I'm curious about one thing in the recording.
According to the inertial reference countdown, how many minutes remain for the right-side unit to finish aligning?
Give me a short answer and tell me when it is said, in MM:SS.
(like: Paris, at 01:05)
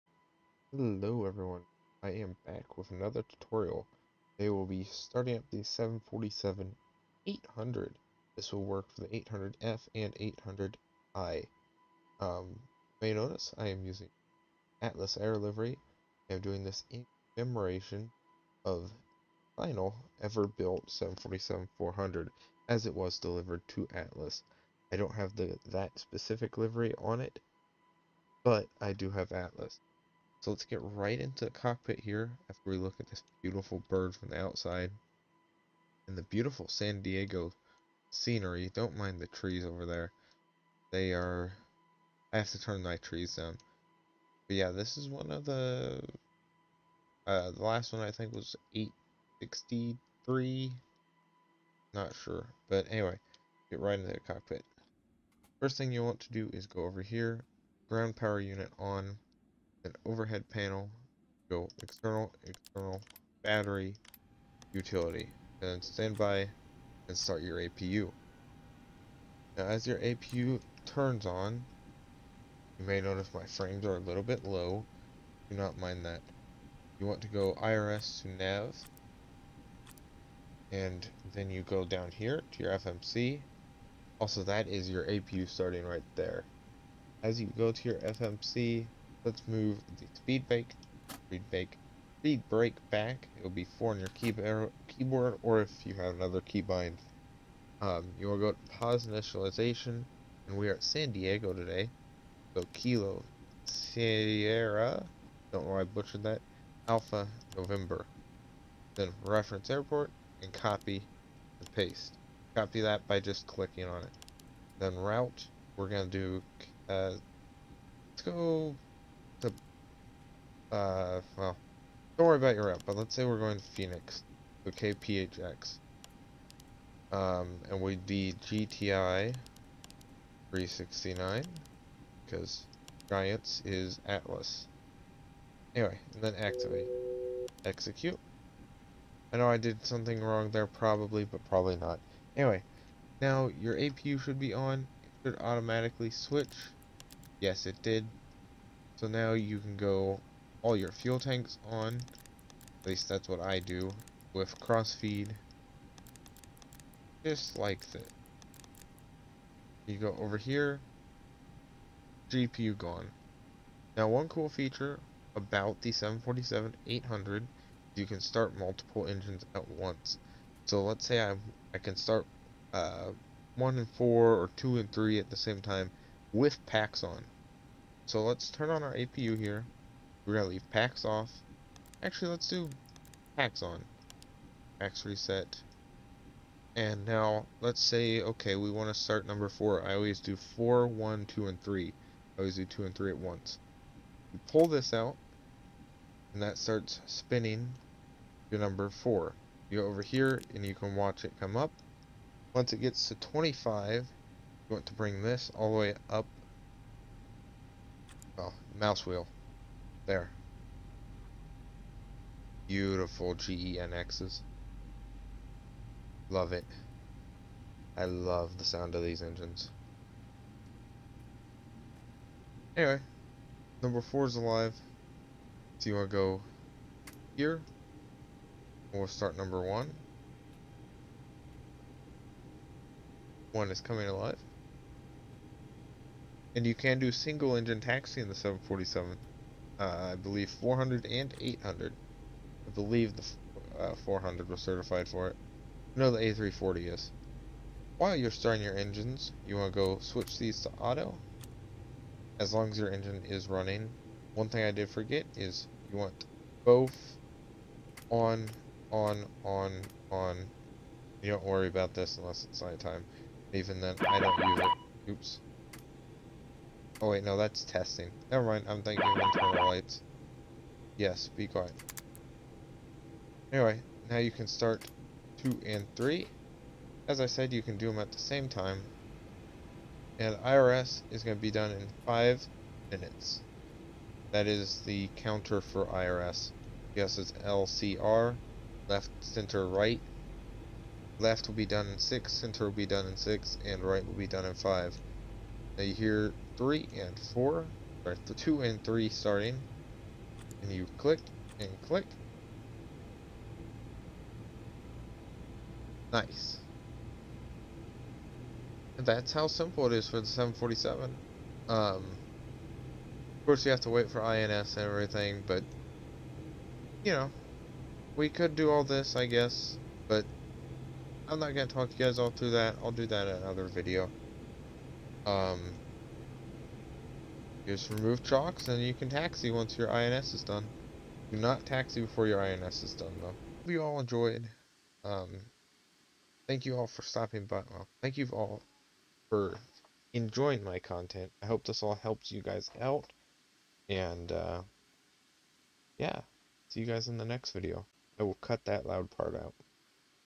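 5, at 04:53.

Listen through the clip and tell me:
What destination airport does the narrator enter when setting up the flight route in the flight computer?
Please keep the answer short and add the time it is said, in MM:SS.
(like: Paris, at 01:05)
Phoenix, at 02:03.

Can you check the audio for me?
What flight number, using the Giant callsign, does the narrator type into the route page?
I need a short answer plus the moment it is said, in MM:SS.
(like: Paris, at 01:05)
GTI 369, at 02:08.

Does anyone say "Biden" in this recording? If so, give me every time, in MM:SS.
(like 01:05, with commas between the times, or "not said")
not said.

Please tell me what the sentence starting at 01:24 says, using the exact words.
Also that is your APU starting right there.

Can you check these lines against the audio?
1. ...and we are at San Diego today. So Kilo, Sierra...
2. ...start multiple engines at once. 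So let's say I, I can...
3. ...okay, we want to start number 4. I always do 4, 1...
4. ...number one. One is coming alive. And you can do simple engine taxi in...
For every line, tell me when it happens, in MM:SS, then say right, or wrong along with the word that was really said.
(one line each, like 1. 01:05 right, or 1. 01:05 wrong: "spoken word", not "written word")
1. 01:40 right
2. 02:48 right
3. 03:08 right
4. 03:49 wrong: "single", not "simple".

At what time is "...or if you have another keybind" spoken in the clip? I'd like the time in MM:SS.
01:35.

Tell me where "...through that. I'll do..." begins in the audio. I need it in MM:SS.
05:22.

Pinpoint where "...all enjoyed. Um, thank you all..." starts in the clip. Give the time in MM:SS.
05:33.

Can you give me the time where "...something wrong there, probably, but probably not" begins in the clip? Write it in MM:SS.
02:19.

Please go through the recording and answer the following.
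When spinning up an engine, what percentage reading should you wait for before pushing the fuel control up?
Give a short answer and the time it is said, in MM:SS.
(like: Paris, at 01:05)
25, at 03:23.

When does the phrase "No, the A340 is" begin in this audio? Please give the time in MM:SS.
04:05.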